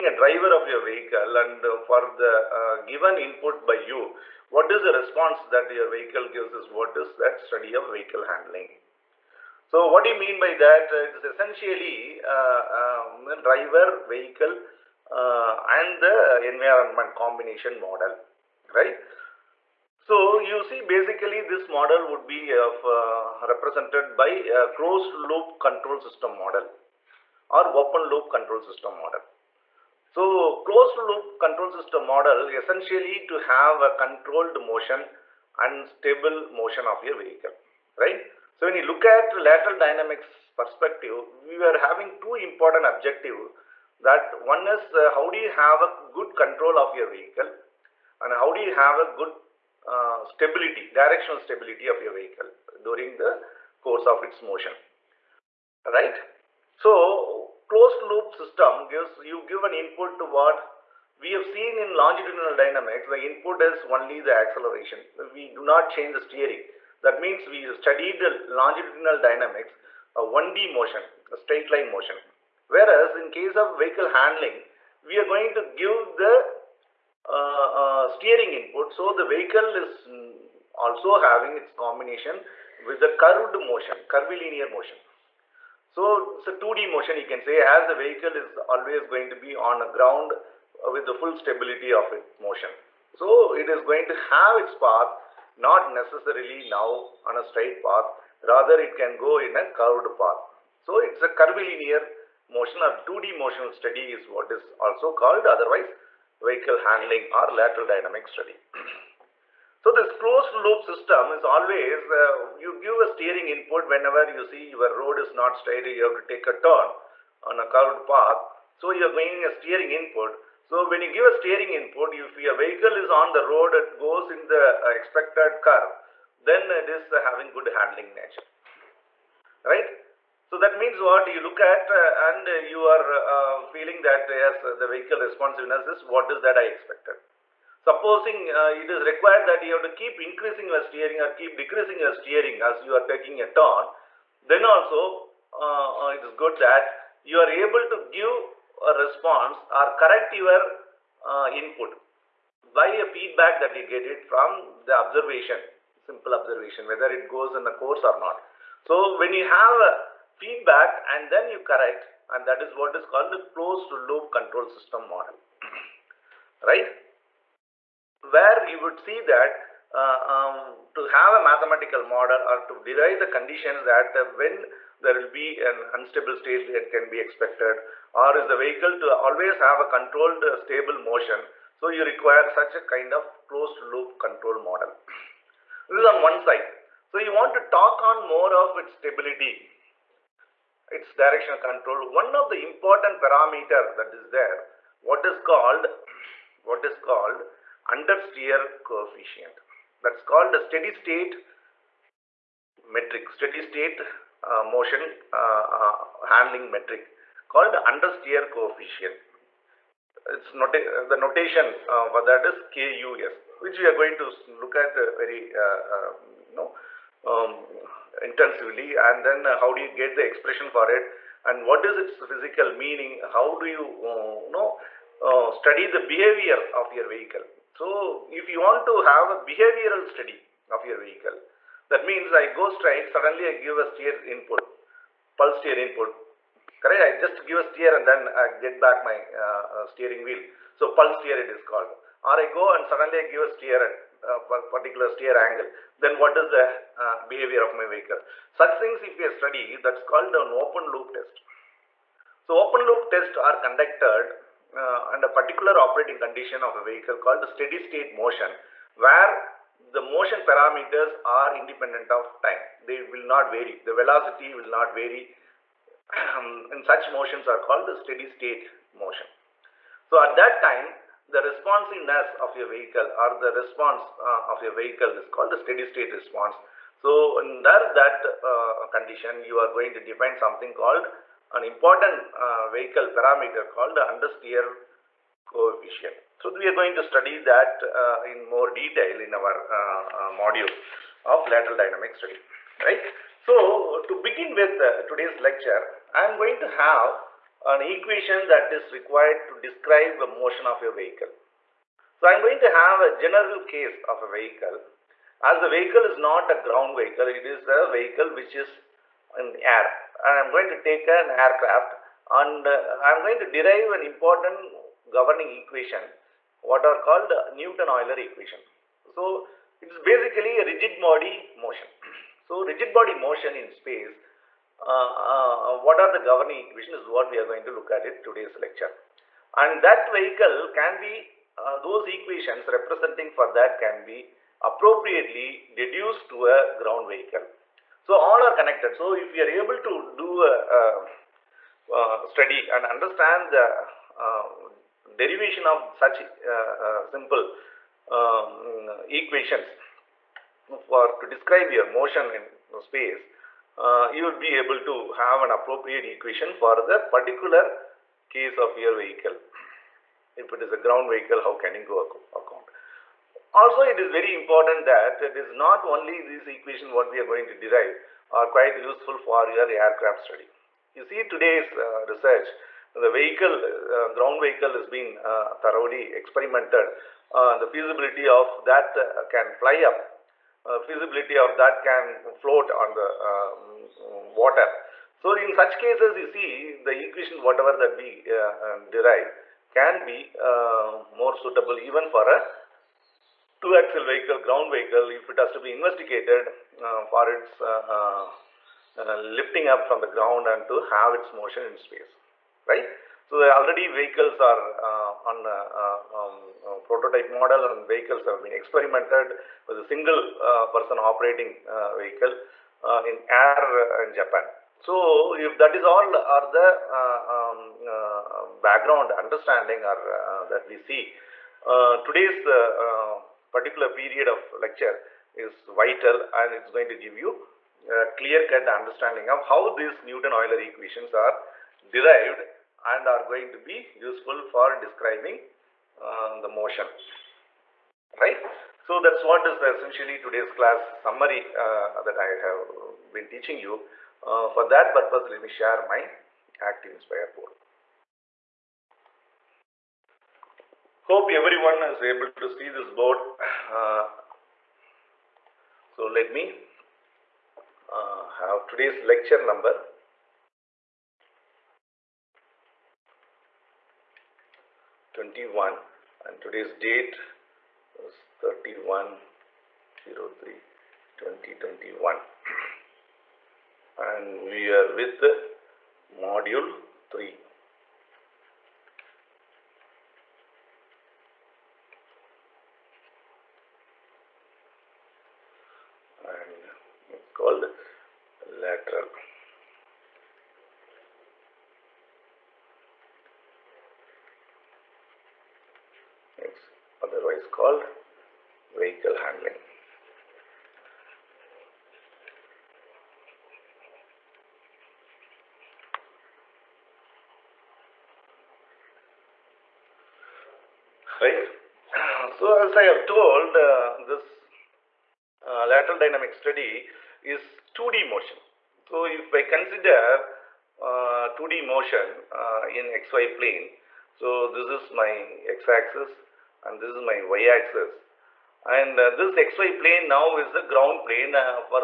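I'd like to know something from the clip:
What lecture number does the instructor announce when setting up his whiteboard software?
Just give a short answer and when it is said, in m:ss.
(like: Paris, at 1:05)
21, at 7:45.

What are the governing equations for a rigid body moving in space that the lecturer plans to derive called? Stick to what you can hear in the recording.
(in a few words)
Newton-Euler equation.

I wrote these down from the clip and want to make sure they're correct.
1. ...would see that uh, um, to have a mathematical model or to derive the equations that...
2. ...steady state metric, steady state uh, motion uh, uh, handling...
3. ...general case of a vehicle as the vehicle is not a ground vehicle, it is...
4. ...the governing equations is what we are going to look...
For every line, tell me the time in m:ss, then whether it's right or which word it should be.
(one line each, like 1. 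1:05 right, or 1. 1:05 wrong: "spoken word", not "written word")
1. 2:48 wrong: "conditions", not "equations"
2. 3:20 right
3. 5:03 right
4. 5:26 right.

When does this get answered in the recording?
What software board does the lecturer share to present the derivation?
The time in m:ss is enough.
7:26.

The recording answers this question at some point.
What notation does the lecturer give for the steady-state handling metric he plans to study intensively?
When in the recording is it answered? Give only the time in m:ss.
3:32.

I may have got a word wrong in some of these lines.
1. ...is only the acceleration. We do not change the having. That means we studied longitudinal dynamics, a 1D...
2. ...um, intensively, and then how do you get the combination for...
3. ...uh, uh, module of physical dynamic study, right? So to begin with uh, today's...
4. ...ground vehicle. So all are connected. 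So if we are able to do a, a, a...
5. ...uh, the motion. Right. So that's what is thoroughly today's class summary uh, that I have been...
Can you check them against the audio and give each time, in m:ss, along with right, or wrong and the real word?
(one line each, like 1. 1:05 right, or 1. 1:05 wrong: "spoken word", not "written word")
1. 1:03 wrong: "steering", not "having"
2. 3:37 wrong: "expression", not "combination"
3. 4:49 wrong: "lateral", not "physical"
4. 5:36 right
5. 7:16 wrong: "essentially", not "thoroughly".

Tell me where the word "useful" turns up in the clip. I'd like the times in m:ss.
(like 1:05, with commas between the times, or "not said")
6:08, 7:13.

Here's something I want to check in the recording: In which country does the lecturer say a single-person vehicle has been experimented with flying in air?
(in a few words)
Japan.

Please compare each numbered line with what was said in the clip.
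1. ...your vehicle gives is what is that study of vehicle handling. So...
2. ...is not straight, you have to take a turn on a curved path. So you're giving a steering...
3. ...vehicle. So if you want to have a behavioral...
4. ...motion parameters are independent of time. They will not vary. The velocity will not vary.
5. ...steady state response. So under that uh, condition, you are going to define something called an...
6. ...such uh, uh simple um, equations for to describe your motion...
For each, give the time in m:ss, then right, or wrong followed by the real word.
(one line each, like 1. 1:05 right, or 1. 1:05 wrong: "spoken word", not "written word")
1. 0:05 right
2. 1:55 right
3. 3:47 right
4. 4:19 right
5. 4:35 right
6. 5:45 right.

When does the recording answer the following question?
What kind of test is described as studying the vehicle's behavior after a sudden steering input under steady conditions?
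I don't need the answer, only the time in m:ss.
4:10.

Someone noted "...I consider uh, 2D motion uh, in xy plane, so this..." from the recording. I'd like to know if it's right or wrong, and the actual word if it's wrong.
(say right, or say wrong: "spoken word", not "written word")
right.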